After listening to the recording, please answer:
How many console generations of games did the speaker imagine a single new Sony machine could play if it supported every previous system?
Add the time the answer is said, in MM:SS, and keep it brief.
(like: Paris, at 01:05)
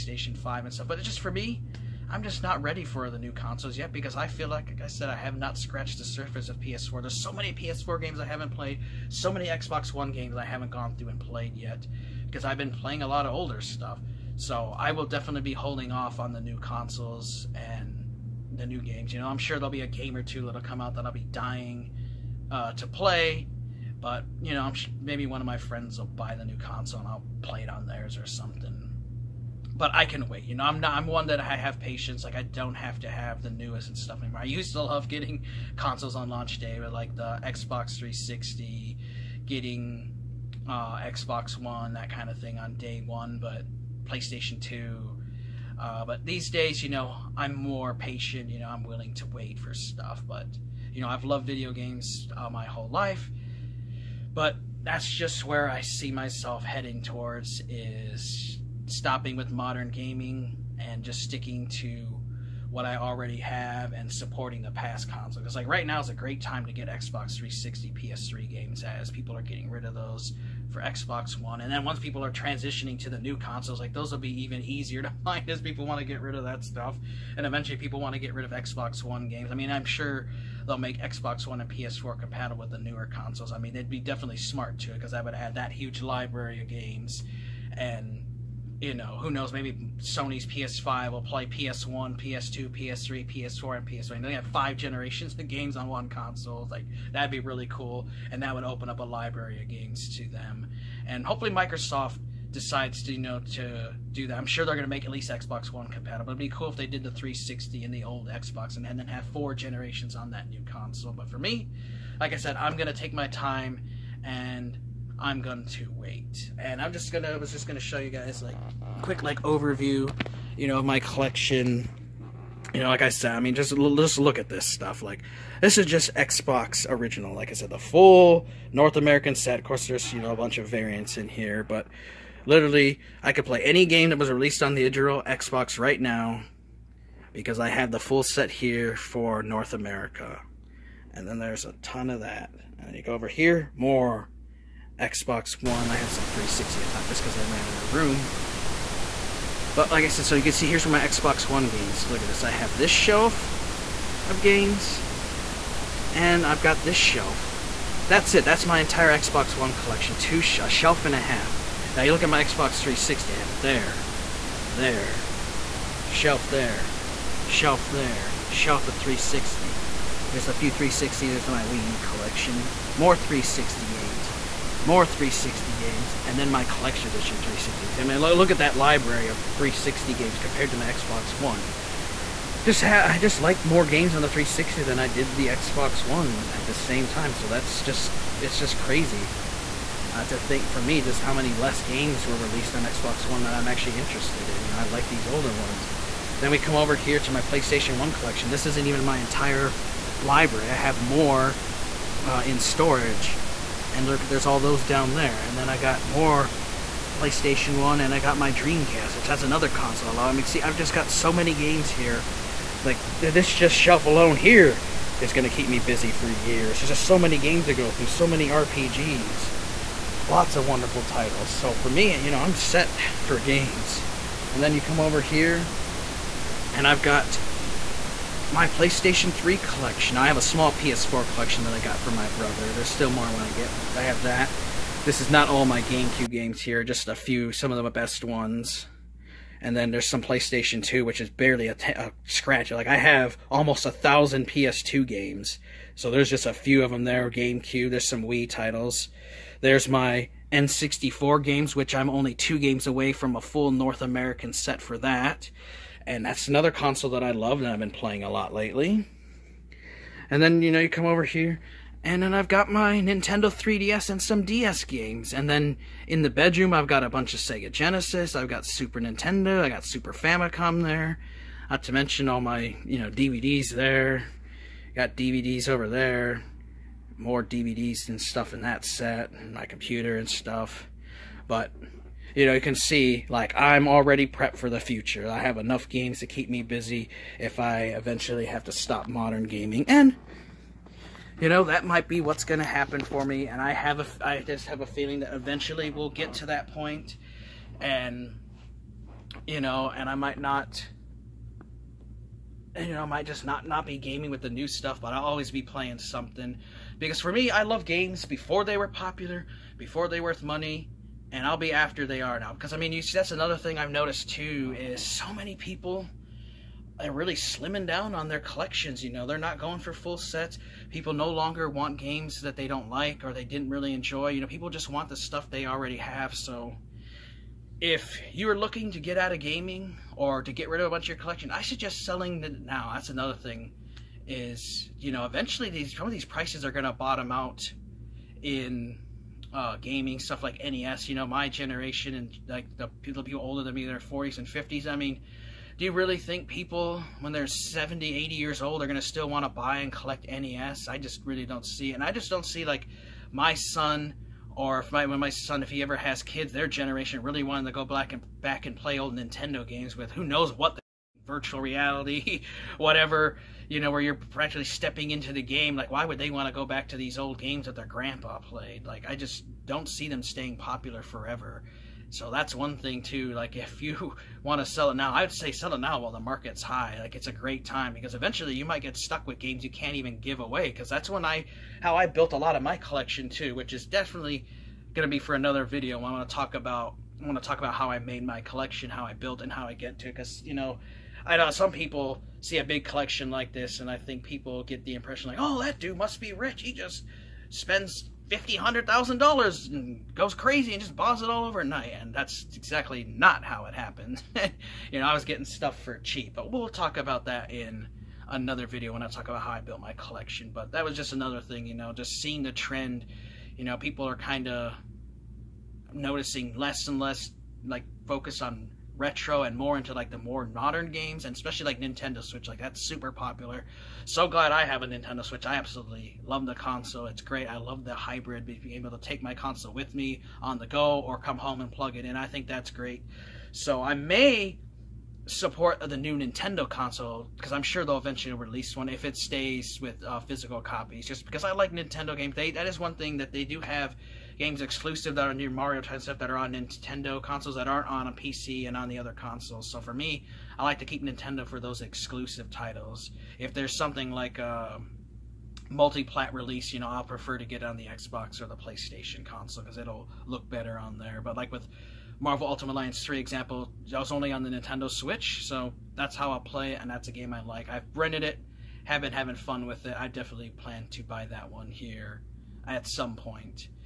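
5, at 01:34.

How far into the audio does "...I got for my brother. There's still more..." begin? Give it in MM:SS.
03:51.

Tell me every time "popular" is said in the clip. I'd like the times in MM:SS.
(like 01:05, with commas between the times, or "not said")
05:08, 06:10, 07:03.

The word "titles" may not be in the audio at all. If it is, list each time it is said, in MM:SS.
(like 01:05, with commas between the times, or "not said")
03:41, 04:08, 07:32.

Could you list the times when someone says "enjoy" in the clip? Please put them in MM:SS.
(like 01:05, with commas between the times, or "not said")
05:23.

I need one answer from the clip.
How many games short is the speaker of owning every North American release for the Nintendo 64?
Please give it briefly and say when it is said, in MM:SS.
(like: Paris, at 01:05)
2, at 04:12.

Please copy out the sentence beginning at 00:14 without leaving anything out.
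So I will definitely be holding off on the new consoles and the new games.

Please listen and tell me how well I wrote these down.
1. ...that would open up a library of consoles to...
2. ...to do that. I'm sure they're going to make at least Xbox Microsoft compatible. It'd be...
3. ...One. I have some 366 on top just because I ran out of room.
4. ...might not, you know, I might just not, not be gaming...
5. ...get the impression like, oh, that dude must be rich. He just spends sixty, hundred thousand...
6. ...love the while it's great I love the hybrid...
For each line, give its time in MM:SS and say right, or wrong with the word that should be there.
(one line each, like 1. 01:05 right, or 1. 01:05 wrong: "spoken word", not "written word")
1. 01:38 wrong: "games", not "consoles"
2. 01:43 wrong: "One", not "Microsoft"
3. 02:25 wrong: "360", not "366"
4. 05:00 right
5. 06:34 wrong: "fifty", not "sixty"
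6. 07:06 wrong: "console", not "while".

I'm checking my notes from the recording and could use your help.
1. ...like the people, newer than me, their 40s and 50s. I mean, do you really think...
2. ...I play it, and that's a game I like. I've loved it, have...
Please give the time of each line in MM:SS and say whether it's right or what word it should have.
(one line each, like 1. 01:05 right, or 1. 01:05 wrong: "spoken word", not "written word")
1. 05:42 wrong: "older", not "newer"
2. 07:46 wrong: "rented", not "loved".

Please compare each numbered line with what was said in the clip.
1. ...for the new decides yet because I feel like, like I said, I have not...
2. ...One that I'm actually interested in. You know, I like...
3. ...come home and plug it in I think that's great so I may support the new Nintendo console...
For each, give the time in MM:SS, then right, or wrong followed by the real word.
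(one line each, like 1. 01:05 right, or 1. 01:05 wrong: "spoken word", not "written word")
1. 00:02 wrong: "consoles", not "decides"
2. 03:13 right
3. 07:11 right.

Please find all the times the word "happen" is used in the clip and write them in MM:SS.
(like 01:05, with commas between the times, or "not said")
04:52, 06:43.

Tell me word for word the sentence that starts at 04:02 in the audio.
Like, I have almost a thousand PS2 games.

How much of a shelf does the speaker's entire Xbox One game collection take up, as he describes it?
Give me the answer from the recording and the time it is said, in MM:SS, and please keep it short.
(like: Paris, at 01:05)
a shelf and a half, at 02:40.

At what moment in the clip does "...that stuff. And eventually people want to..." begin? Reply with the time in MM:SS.
01:16.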